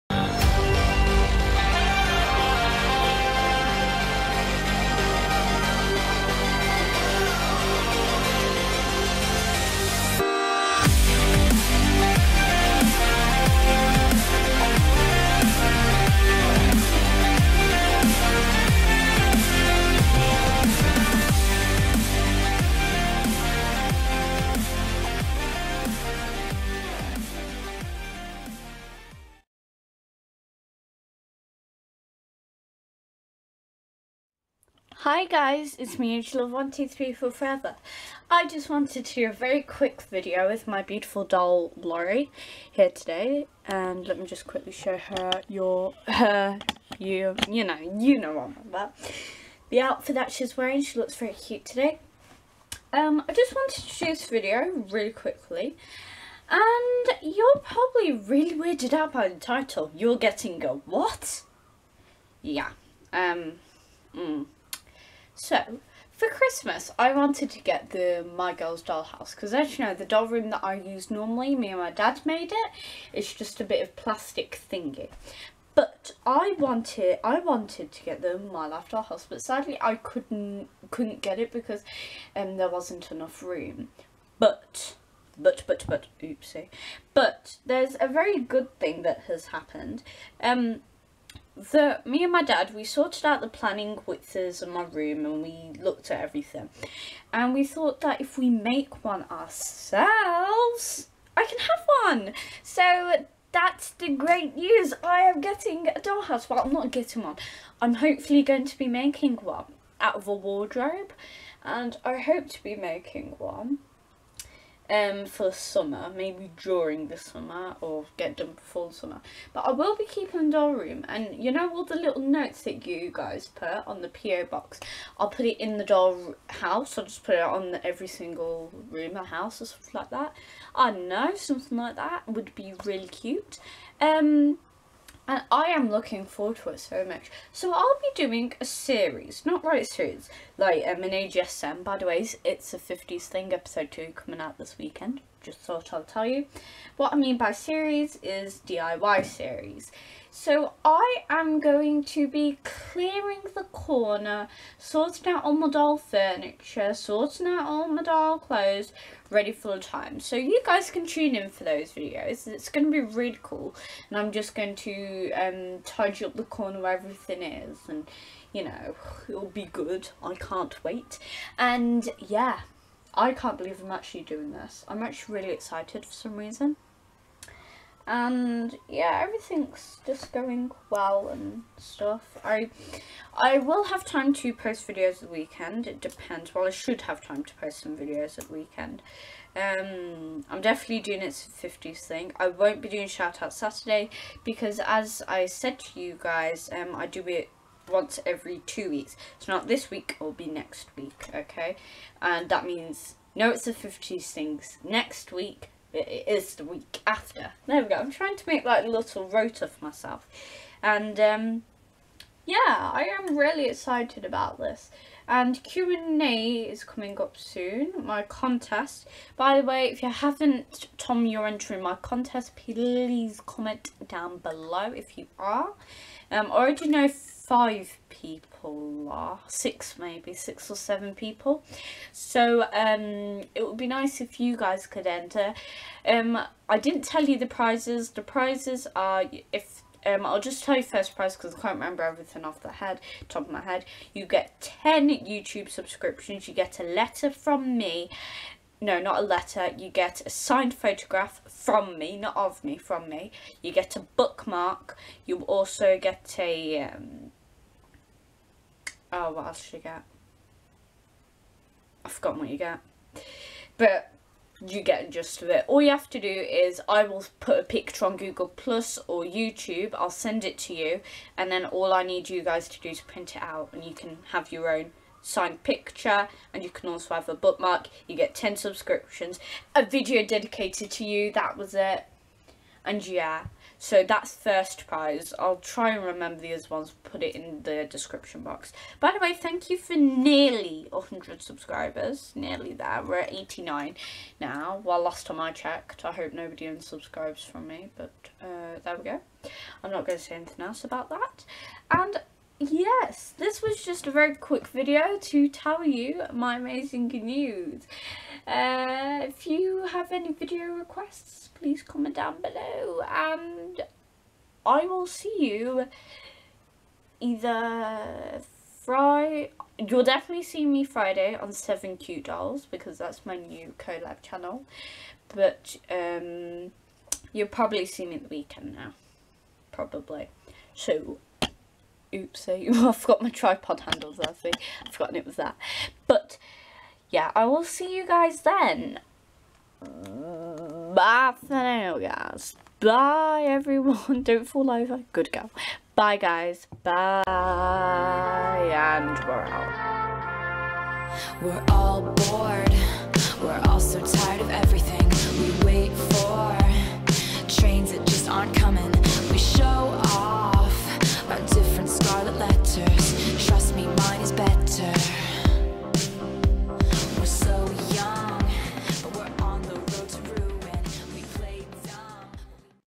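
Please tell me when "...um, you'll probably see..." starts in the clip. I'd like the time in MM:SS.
05:25.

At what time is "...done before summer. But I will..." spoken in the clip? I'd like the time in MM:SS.
01:58.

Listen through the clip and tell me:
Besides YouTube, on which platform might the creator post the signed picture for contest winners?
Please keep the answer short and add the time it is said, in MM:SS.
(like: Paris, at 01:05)
Google Plus, at 04:28.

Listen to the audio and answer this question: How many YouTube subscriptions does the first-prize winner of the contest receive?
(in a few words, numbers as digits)
10.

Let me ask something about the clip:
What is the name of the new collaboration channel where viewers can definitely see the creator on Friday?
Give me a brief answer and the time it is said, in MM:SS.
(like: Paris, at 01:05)
7 Cute Dolls, at 05:21.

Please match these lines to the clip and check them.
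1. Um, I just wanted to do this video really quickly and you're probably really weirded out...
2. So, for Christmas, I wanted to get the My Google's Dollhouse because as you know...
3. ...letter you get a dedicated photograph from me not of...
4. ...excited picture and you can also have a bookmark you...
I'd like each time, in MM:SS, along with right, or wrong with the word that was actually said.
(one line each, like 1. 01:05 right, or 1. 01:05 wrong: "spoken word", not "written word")
1. 00:52 right
2. 01:05 wrong: "Girl", not "Google"
3. 04:09 wrong: "signed", not "dedicated"
4. 04:35 wrong: "signed", not "excited".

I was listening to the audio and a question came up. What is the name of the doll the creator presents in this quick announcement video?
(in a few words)
Laurie.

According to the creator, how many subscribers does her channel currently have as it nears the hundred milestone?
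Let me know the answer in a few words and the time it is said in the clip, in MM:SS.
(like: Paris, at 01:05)
89, at 04:53.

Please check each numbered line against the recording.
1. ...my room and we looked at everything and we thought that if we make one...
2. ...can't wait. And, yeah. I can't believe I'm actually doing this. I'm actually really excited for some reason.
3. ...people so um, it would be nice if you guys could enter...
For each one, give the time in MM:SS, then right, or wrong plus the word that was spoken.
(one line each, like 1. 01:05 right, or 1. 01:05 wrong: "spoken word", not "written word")
1. 01:34 right
2. 02:50 right
3. 03:51 right.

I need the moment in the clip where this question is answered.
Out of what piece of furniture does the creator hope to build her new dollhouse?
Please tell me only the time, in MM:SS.
01:50.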